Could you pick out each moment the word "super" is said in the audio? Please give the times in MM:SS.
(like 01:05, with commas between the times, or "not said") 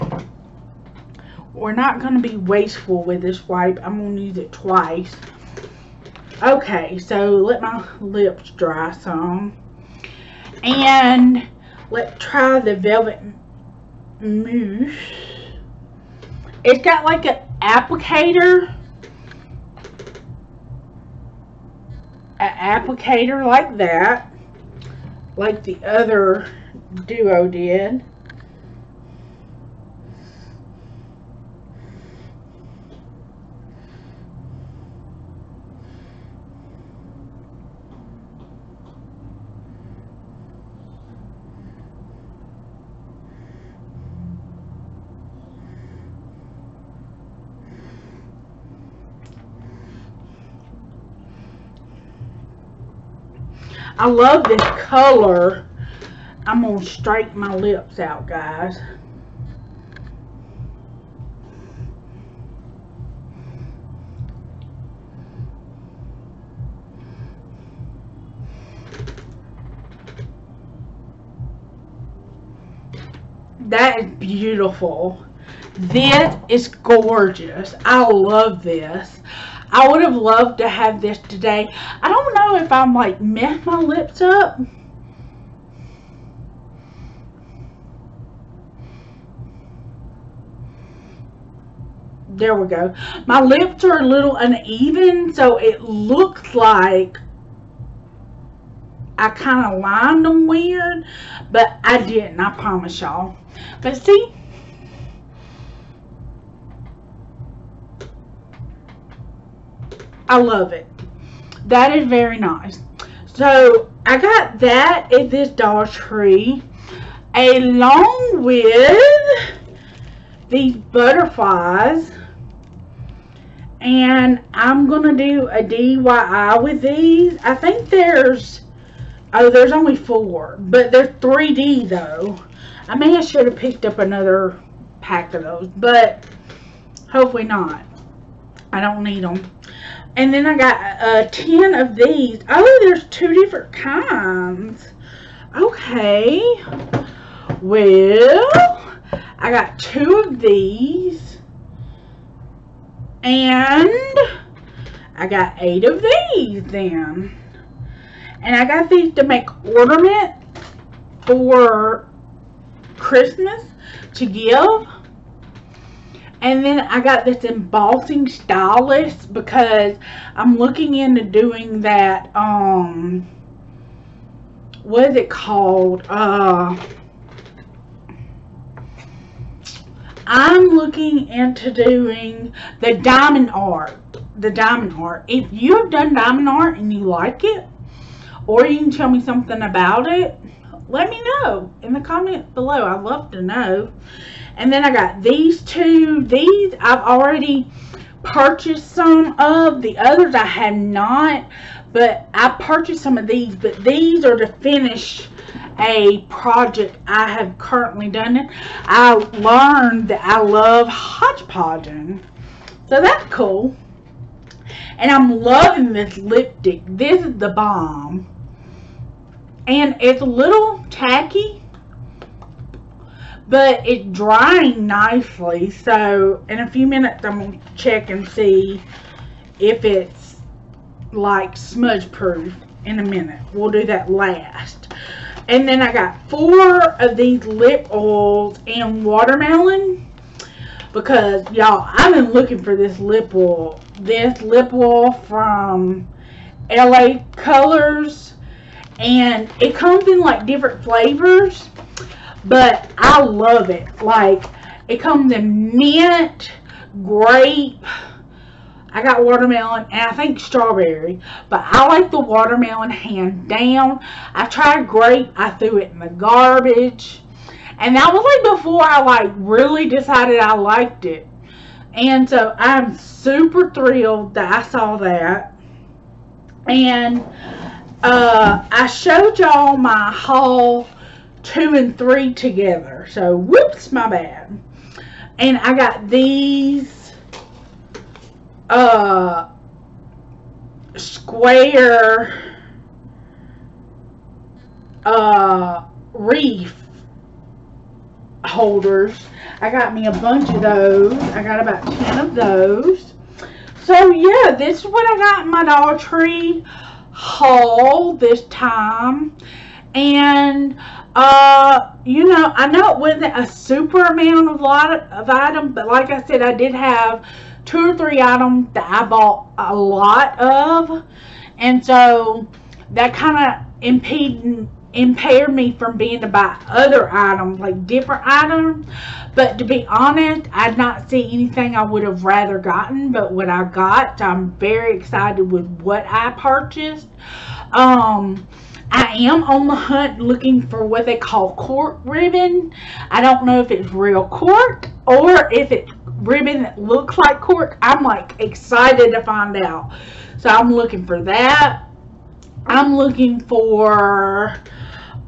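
04:32, 05:13.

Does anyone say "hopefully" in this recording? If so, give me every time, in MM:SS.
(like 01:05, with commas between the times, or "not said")
02:17.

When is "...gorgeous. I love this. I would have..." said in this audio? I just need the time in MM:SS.
01:16.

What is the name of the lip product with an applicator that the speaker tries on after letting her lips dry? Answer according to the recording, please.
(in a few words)
Velvet Mousse.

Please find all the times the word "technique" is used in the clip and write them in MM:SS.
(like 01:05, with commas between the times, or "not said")
not said.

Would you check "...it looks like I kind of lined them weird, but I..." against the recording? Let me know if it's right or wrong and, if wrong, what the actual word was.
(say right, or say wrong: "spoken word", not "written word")
right.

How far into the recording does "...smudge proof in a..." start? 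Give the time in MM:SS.
03:51.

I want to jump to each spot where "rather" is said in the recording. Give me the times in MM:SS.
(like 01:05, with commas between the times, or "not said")
05:32.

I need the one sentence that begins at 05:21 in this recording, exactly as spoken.
And so that kind of impeded impair me from being to buy other items, like different items.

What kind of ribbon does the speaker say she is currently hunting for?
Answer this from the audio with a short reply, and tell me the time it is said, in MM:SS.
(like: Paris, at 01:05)
cork ribbon, at 05:41.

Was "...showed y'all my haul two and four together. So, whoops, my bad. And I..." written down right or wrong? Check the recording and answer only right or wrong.
wrong.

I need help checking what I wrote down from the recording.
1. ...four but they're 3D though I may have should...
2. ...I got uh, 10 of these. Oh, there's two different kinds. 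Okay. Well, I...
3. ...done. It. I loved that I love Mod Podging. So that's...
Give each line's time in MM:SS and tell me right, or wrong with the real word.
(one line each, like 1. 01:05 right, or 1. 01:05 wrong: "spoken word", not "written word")
1. 02:09 right
2. 02:20 right
3. 03:28 wrong: "learned", not "loved".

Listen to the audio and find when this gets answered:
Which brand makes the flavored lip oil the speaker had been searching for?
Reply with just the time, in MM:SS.
04:06.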